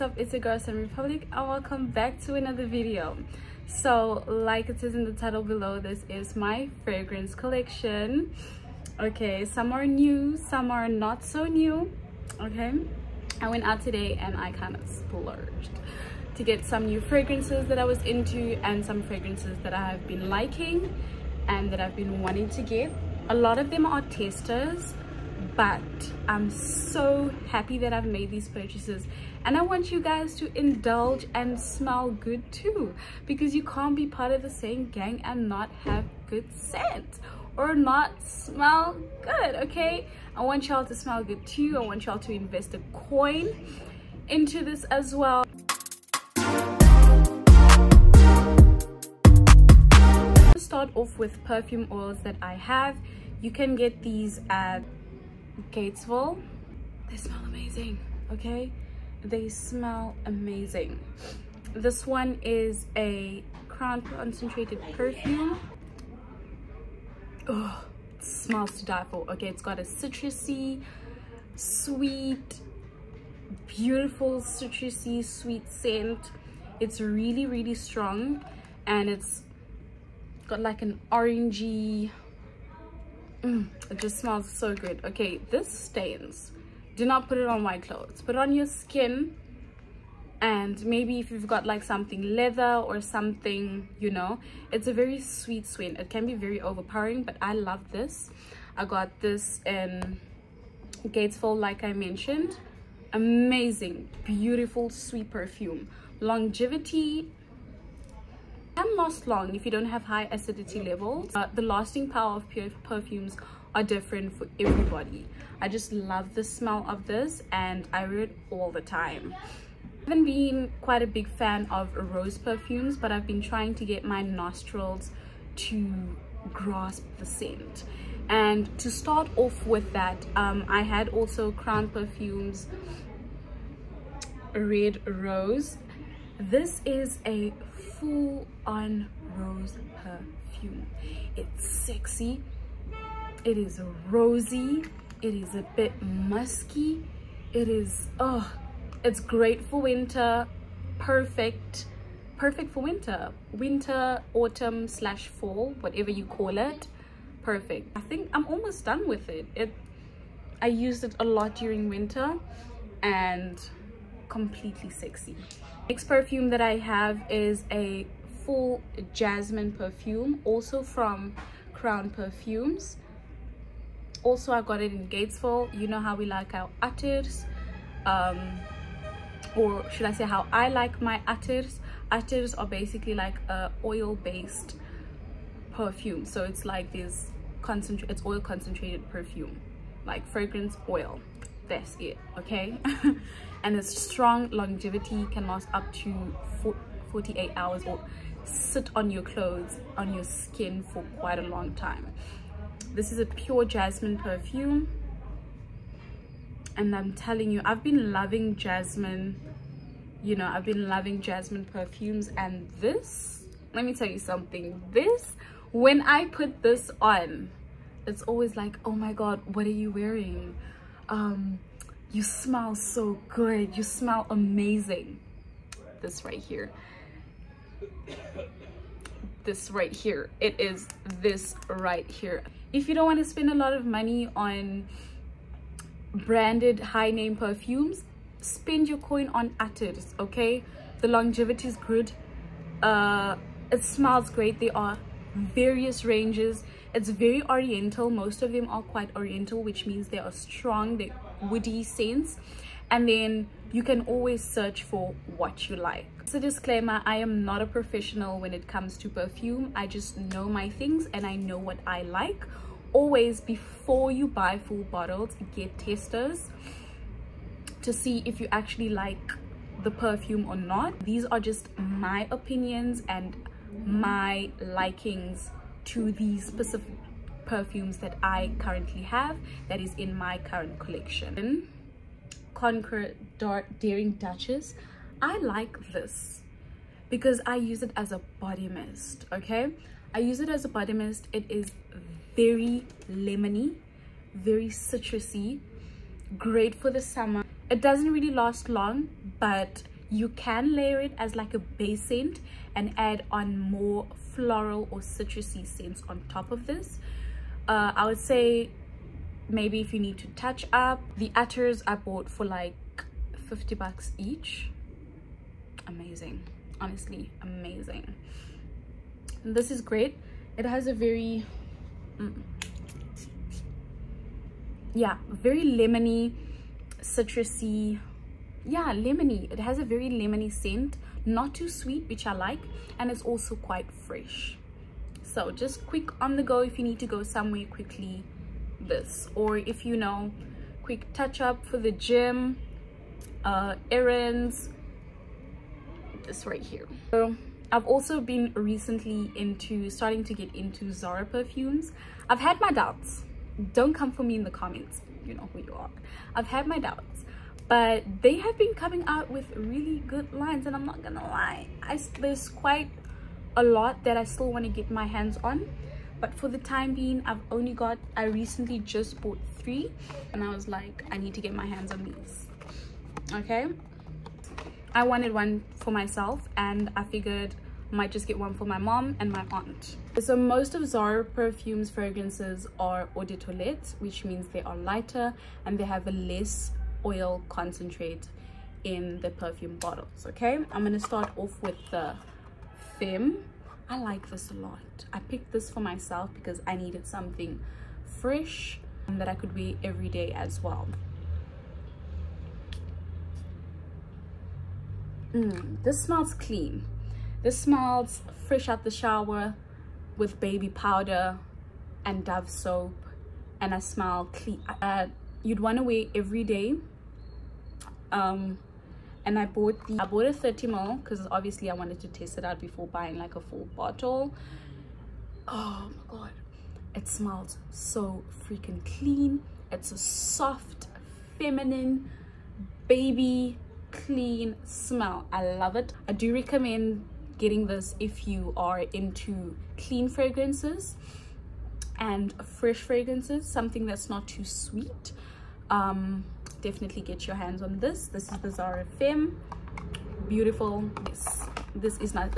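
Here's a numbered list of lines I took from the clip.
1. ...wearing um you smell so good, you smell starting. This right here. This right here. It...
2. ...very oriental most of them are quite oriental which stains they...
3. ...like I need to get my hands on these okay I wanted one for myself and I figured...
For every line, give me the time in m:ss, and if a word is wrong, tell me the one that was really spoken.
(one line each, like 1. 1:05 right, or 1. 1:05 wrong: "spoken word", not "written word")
1. 3:39 wrong: "amazing", not "starting"
2. 4:07 wrong: "means", not "stains"
3. 6:10 right.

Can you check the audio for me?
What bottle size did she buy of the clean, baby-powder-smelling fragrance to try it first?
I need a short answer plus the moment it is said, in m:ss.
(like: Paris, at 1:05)
30 ml, at 7:00.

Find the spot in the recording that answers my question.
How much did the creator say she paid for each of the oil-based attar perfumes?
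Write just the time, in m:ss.
5:13.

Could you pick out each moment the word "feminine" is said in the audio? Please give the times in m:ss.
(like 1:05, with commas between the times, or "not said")
7:11.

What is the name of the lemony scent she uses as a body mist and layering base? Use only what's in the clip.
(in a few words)
Dark Daring Duchess.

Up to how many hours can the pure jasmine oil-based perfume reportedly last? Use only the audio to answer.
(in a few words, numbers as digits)
48 hours.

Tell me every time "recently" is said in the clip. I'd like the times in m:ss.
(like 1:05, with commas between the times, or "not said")
5:48, 6:08.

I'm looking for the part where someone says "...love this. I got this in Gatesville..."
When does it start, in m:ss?
1:37.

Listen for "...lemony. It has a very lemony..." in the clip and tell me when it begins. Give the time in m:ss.
5:28.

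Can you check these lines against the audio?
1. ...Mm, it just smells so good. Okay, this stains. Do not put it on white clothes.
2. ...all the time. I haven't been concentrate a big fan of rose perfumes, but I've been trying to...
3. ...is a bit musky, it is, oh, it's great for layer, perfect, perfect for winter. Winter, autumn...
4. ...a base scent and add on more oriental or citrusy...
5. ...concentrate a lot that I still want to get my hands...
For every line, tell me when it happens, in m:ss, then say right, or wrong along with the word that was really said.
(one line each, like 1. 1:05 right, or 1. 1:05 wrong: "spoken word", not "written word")
1. 1:23 right
2. 1:58 wrong: "quite", not "concentrate"
3. 2:25 wrong: "winter", not "layer"
4. 5:01 wrong: "floral", not "oriental"
5. 6:02 wrong: "quite", not "concentrate".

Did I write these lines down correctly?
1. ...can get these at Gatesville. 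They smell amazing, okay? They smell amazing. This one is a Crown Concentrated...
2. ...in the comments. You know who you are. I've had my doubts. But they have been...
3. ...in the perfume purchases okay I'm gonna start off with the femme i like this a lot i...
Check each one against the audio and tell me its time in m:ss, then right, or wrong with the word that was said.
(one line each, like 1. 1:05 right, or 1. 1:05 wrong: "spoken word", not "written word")
1. 0:53 right
2. 5:54 right
3. 6:28 wrong: "bottles", not "purchases".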